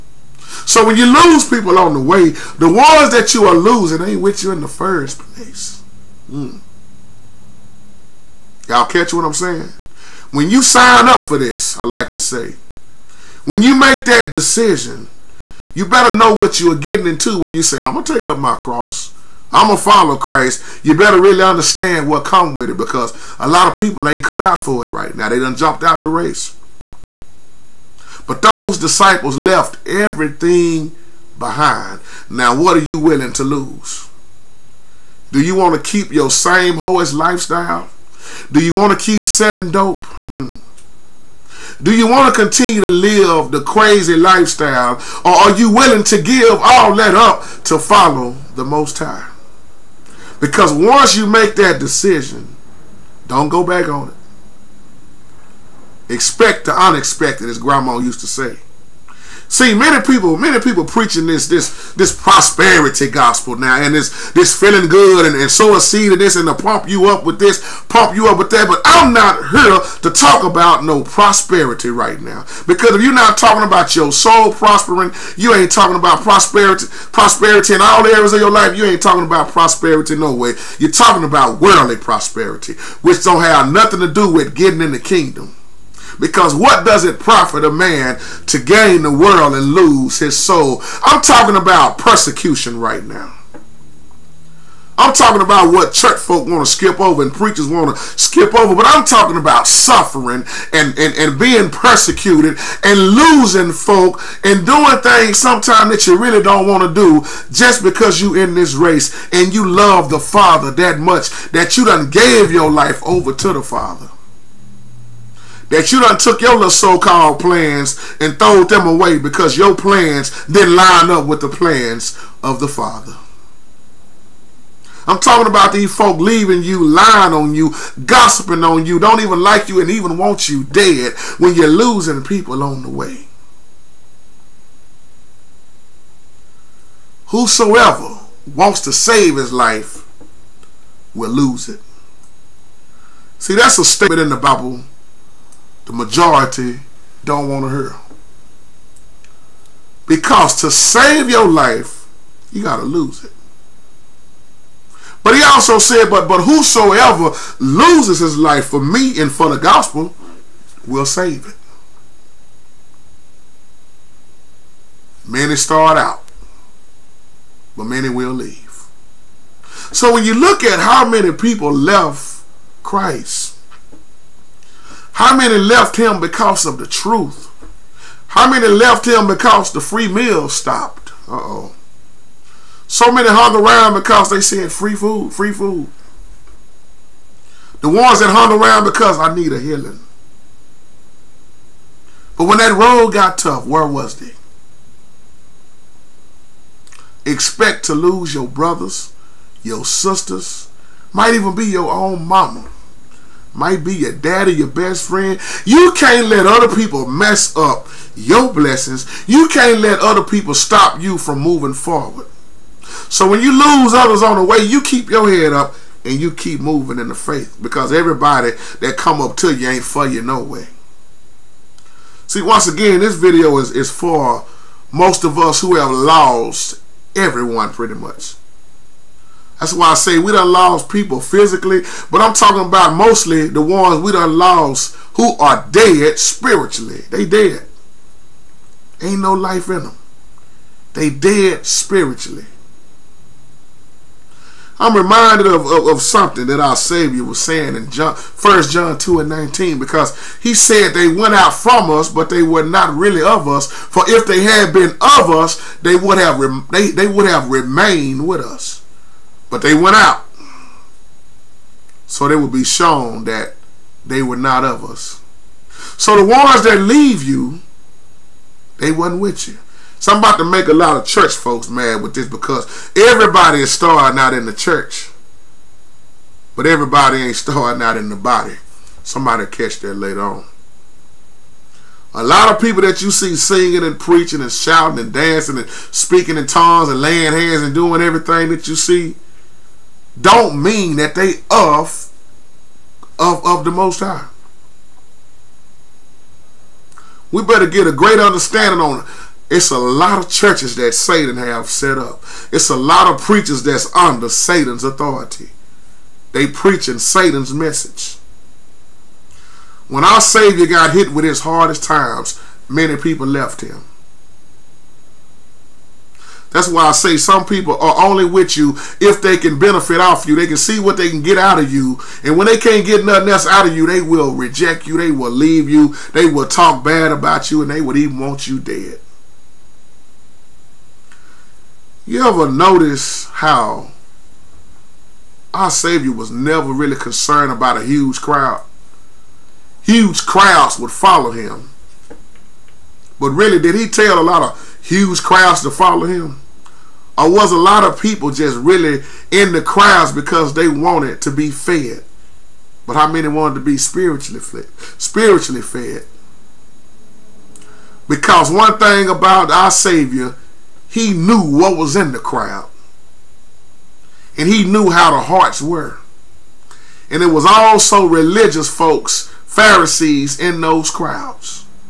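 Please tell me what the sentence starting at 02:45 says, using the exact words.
Many start out, but many will leave.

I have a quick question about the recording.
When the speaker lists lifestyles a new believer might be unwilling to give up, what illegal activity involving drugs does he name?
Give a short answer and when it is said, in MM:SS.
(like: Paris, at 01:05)
Selling dope, at 00:39.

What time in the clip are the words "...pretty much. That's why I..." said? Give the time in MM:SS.
03:47.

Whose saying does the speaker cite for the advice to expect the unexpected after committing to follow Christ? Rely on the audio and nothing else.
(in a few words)
Grandma.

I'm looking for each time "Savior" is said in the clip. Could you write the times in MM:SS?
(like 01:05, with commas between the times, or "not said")
04:06, 05:10, 05:35, 05:59.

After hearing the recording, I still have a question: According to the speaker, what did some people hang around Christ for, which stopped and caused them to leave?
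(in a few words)
Free meal.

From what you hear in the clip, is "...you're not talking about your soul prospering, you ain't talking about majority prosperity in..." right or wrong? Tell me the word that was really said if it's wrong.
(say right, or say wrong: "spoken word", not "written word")
wrong: "prosperity", not "majority".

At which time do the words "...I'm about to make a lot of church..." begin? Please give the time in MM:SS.
04:30.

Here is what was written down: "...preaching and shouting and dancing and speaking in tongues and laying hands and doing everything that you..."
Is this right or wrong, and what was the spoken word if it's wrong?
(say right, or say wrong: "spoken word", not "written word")
right.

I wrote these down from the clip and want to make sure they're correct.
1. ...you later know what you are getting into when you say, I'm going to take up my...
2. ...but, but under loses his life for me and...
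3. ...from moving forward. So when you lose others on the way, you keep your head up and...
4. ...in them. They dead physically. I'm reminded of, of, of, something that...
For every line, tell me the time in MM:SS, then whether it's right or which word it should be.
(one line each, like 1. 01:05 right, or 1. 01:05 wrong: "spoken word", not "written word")
1. 00:15 wrong: "better", not "later"
2. 02:36 wrong: "whosoever", not "under"
3. 03:31 right
4. 03:59 wrong: "spiritually", not "physically".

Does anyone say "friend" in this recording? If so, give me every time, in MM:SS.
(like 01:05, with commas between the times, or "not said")
03:25.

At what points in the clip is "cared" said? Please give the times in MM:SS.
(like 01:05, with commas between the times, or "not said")
not said.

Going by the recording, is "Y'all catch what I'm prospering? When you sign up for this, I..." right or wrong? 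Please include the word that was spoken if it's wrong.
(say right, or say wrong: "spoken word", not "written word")
wrong: "saying", not "prospering".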